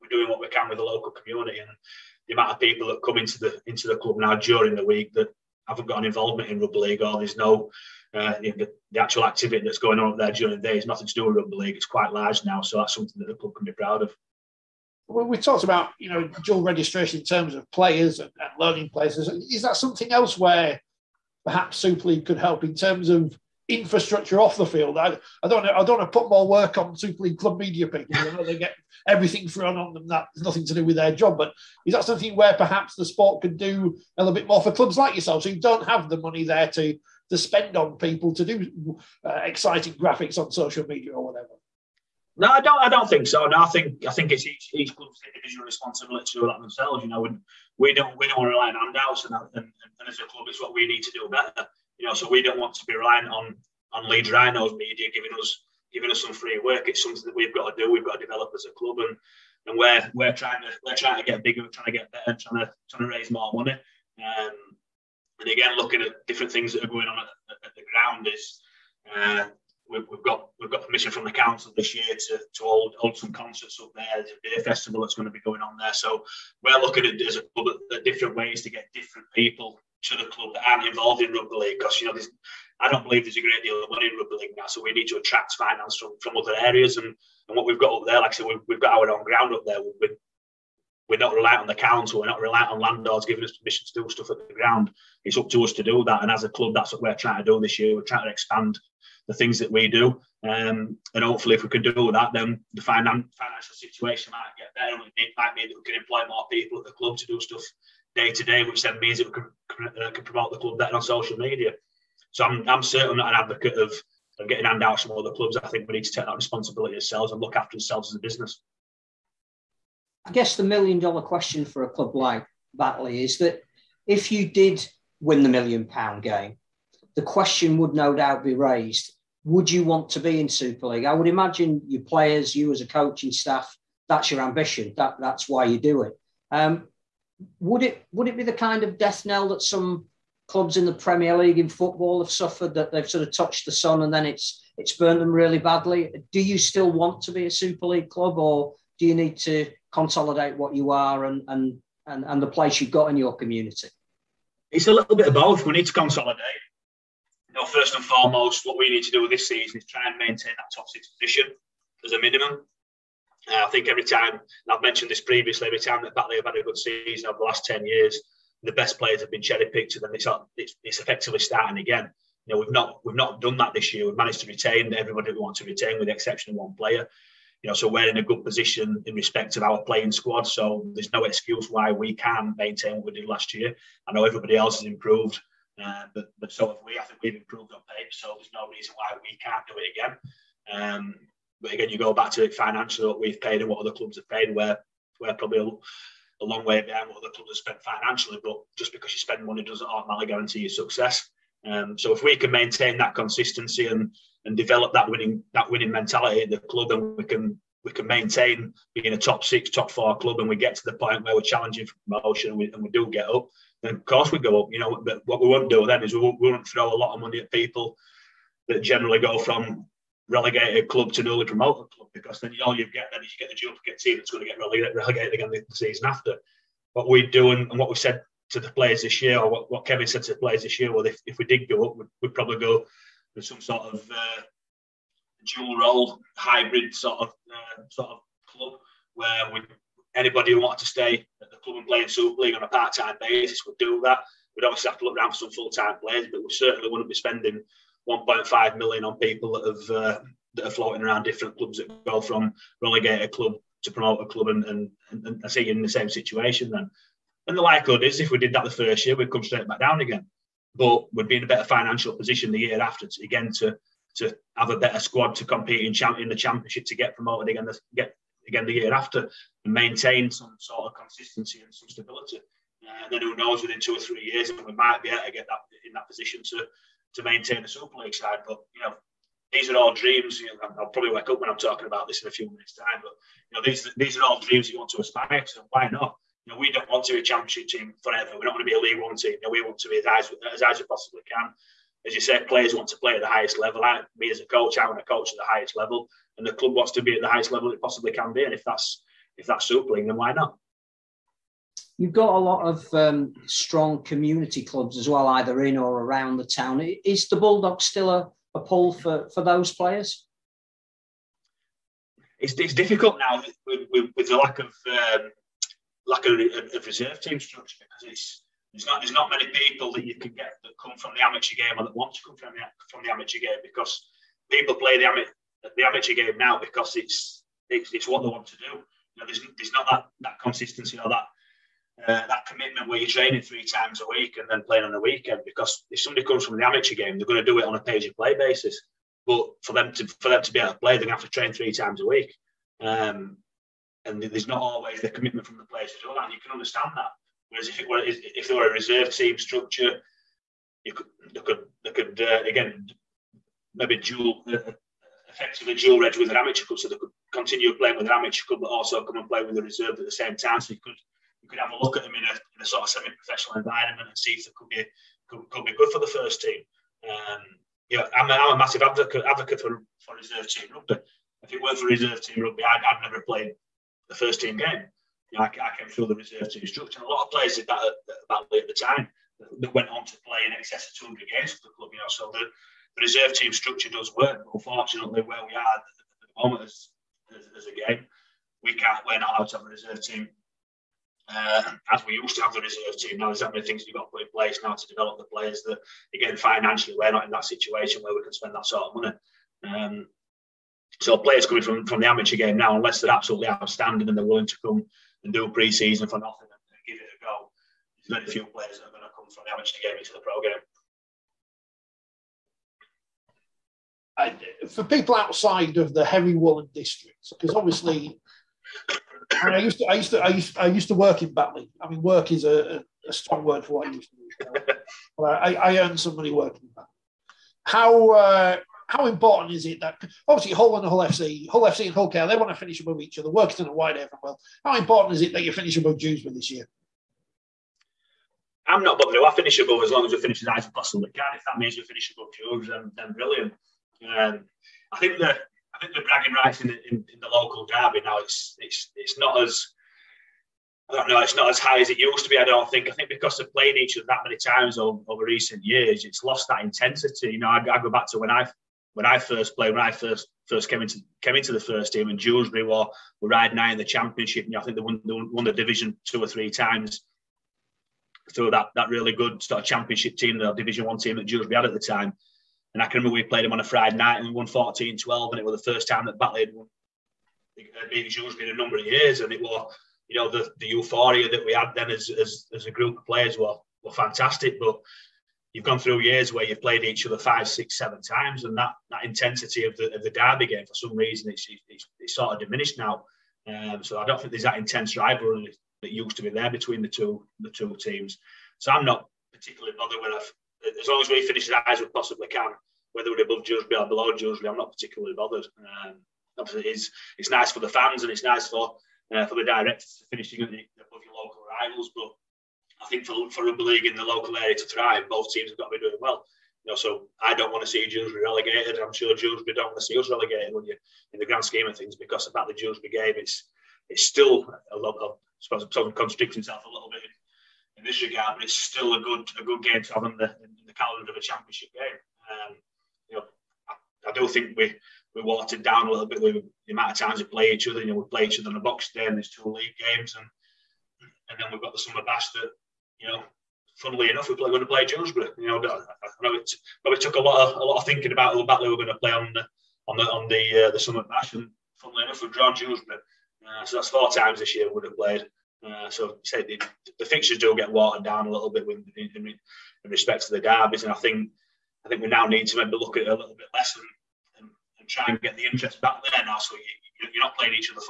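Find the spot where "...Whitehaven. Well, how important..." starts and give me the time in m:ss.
7:13.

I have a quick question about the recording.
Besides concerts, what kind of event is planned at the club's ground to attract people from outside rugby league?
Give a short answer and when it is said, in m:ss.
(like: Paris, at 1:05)
beer festival, at 1:14.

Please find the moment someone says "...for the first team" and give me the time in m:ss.
6:05.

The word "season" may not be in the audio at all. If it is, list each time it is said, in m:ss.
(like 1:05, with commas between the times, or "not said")
2:39, 2:46, 3:45, 6:45.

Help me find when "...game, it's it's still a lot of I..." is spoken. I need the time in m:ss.
8:42.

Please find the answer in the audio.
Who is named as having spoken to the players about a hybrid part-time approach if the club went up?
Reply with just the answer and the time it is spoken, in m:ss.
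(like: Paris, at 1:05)
Kevin, at 3:49.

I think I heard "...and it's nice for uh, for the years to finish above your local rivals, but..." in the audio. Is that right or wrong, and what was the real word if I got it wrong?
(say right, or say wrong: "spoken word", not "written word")
wrong: "directors", not "years".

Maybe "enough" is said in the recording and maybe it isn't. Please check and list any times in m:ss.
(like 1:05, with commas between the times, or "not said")
9:04, 9:12.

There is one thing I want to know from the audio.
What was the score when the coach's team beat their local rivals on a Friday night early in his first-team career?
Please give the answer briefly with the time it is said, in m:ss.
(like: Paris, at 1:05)
14-12, at 7:54.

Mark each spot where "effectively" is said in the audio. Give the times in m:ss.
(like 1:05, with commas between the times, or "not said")
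2:50, 5:55.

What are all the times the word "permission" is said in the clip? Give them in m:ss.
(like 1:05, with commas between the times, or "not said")
1:10, 1:33.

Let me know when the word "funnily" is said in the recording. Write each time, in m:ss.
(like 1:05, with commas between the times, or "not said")
9:03, 9:11.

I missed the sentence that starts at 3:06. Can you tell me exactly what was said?
I think we've improved on paper, so there's no reason why we can't do it again.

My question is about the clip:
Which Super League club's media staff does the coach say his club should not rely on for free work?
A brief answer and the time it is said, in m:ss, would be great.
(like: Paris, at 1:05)
Leeds Rhinos, at 0:54.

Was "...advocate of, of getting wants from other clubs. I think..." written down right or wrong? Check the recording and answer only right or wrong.
wrong.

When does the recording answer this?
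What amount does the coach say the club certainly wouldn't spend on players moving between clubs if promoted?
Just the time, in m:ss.
4:08.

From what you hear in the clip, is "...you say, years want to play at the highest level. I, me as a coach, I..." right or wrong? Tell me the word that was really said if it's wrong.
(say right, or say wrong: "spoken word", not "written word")
wrong: "players", not "years".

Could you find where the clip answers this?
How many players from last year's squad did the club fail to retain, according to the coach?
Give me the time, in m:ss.
2:56.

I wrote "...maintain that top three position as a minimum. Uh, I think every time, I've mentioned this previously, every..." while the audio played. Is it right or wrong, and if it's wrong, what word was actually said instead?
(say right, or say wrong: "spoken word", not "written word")
wrong: "six", not "three".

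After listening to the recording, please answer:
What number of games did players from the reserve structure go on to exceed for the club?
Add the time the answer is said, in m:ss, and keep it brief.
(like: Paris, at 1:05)
200, at 6:20.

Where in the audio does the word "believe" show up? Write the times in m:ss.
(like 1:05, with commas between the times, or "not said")
1:23.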